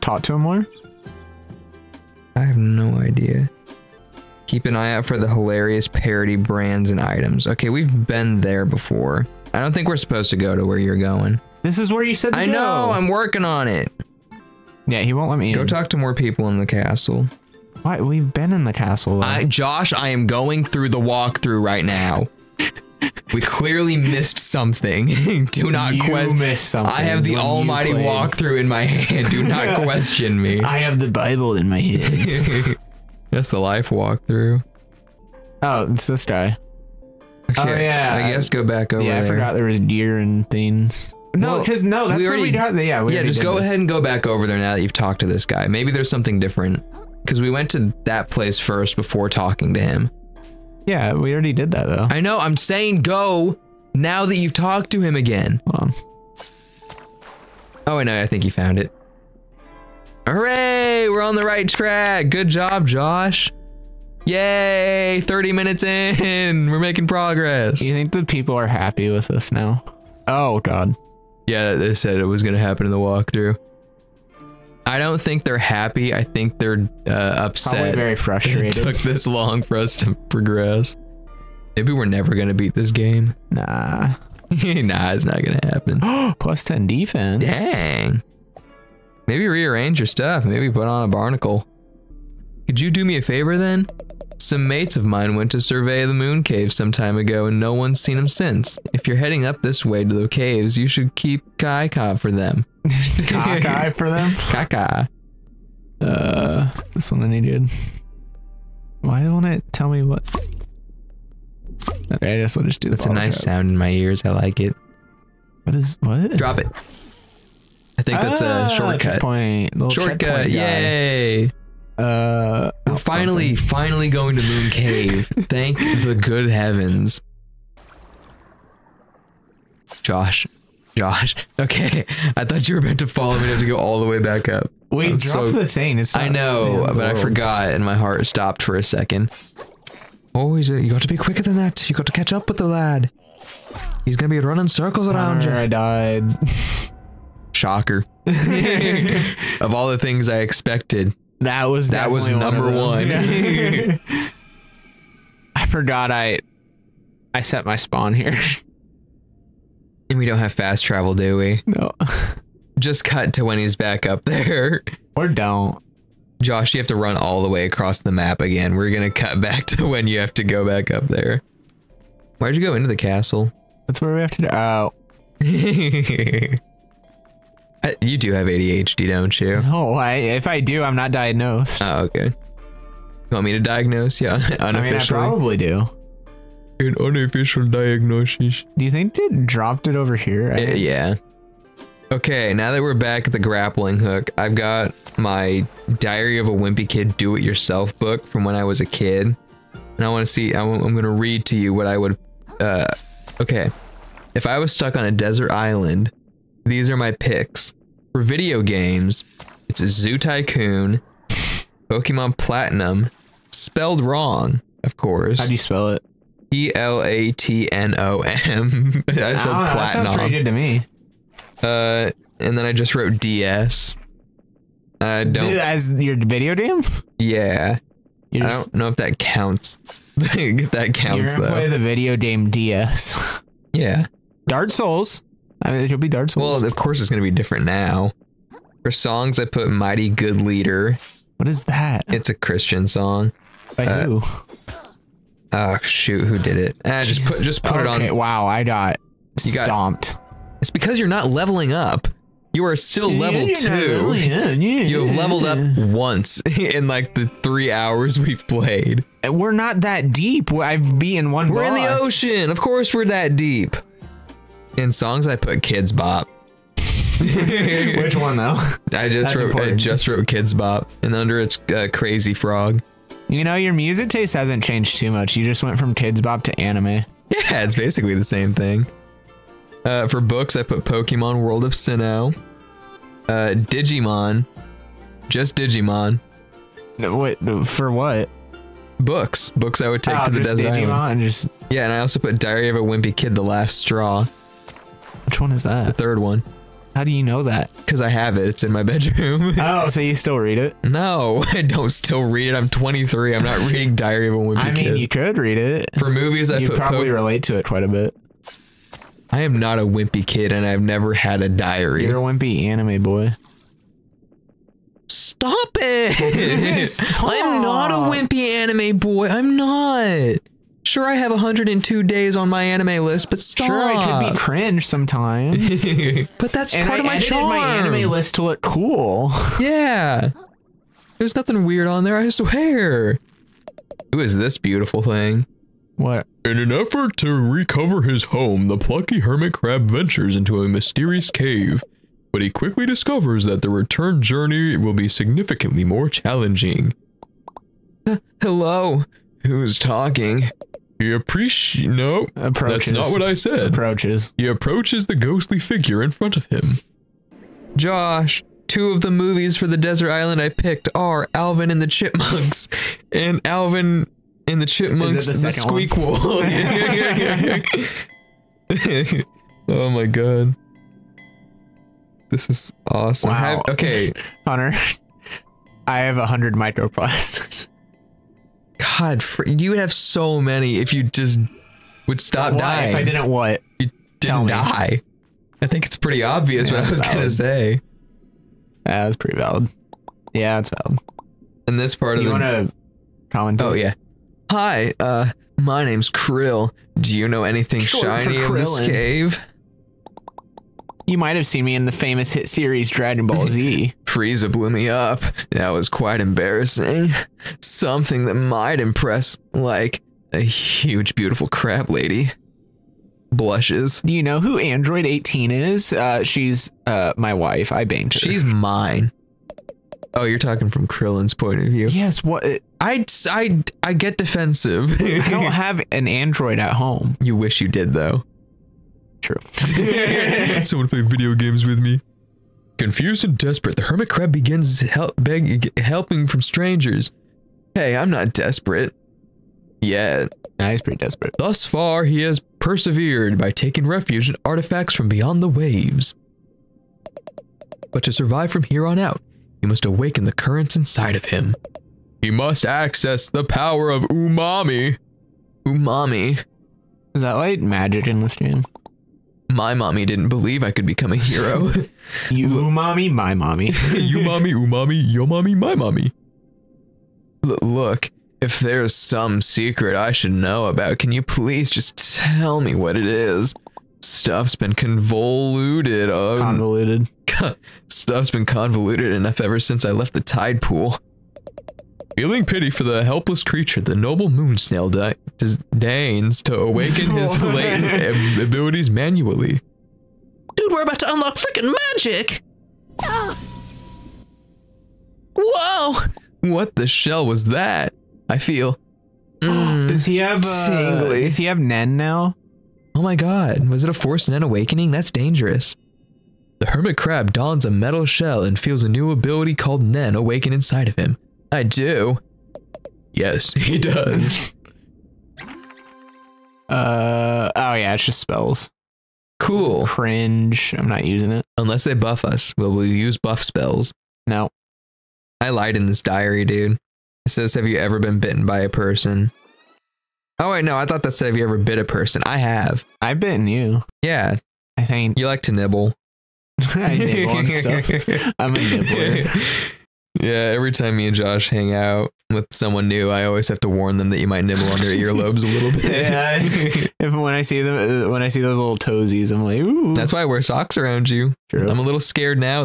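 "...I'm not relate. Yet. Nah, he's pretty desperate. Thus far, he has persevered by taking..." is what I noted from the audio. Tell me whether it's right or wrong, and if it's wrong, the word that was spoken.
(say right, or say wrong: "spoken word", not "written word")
wrong: "desperate", not "relate".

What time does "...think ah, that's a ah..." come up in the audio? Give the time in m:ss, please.
1:58.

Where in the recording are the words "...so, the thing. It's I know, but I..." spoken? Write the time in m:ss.
2:15.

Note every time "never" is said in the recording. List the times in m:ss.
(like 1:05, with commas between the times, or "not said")
1:22, 5:10.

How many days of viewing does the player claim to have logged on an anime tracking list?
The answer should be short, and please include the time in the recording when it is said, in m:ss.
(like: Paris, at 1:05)
102, at 5:21.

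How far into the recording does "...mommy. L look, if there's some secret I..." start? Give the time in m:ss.
7:45.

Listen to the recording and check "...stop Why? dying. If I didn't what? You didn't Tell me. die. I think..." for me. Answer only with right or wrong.
right.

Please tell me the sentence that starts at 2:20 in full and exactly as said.
oh, you got to be quicker than that.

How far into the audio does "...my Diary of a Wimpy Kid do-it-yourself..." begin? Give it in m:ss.
3:15.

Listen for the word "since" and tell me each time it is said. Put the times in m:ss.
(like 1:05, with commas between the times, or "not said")
1:38, 7:59.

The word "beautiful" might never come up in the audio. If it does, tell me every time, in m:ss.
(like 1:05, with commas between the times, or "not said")
5:34, 6:51.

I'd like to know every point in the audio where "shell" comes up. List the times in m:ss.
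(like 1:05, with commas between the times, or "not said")
8:16, 8:28.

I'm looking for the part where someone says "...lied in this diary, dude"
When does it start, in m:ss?
8:45.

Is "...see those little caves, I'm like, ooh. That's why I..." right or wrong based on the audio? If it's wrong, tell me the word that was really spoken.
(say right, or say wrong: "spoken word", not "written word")
wrong: "toesies", not "caves".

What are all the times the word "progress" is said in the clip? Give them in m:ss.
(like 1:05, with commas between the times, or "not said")
1:07, 1:20.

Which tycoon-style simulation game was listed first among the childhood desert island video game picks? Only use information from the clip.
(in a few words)
Zoo Tycoon.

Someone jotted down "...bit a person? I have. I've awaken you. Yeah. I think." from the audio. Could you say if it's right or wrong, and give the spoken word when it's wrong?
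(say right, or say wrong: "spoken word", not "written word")
wrong: "bitten", not "awaken".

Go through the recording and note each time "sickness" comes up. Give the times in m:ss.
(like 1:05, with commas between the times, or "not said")
not said.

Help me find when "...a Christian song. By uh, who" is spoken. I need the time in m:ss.
4:02.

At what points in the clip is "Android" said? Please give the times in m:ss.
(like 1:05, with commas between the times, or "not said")
6:54, 7:06.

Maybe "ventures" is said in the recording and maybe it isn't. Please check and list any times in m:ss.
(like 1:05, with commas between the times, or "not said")
5:39.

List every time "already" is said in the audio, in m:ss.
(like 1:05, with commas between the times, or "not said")
0:42, 0:51.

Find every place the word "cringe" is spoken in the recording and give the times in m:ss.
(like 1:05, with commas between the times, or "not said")
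5:24, 8:39.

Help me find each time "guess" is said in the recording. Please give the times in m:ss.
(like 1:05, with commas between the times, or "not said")
0:38, 1:52.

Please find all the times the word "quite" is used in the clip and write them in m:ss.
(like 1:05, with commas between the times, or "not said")
5:07, 6:45.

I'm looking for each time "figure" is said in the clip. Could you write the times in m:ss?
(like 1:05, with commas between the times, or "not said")
5:55.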